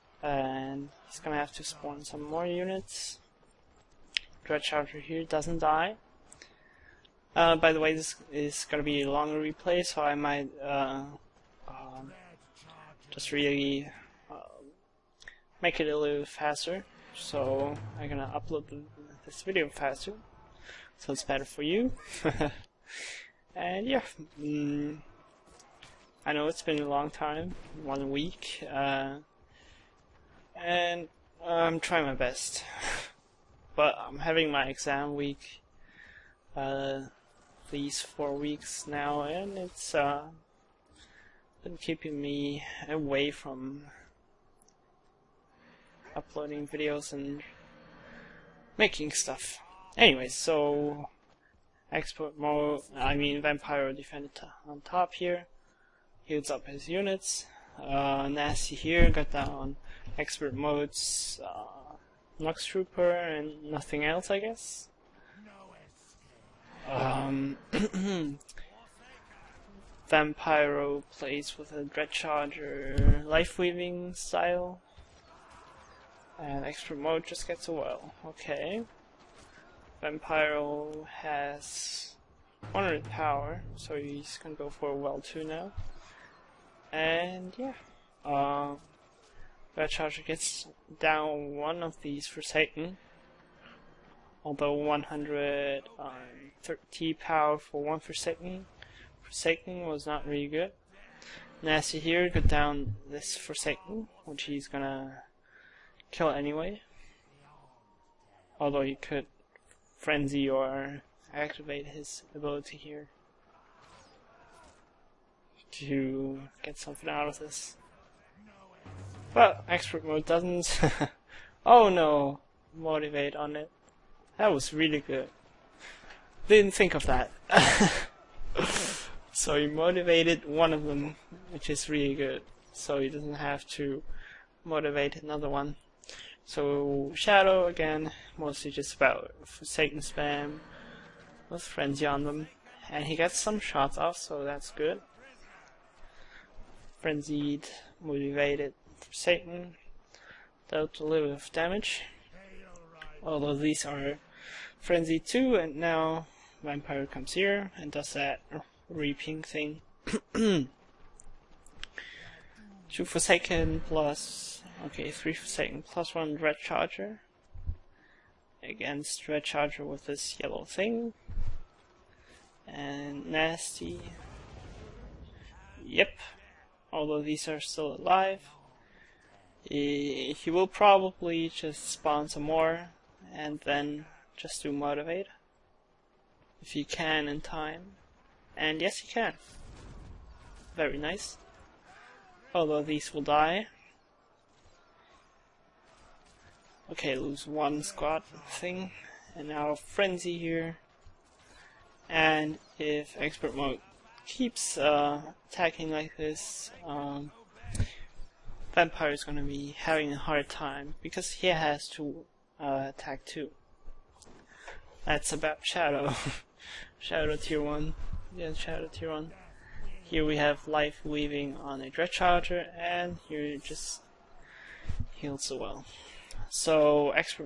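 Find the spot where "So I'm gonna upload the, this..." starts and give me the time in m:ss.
0:17.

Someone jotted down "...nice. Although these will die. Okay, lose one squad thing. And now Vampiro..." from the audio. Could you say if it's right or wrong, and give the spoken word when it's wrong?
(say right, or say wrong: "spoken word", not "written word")
wrong: "Frenzy", not "Vampiro".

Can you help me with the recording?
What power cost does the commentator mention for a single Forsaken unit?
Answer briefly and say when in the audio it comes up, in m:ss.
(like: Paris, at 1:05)
130, at 1:34.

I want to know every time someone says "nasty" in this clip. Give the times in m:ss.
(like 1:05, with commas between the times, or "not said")
0:58, 1:41, 2:53.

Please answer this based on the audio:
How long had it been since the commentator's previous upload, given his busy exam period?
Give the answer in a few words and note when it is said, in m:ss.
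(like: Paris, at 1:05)
one week, at 0:27.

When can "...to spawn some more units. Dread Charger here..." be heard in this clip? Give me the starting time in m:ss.
0:01.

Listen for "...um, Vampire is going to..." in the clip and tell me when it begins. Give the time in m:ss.
3:26.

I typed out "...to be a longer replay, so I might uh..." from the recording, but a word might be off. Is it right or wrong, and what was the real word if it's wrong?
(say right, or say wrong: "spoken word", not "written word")
right.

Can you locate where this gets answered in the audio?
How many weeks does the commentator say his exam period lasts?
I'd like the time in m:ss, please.
0:38.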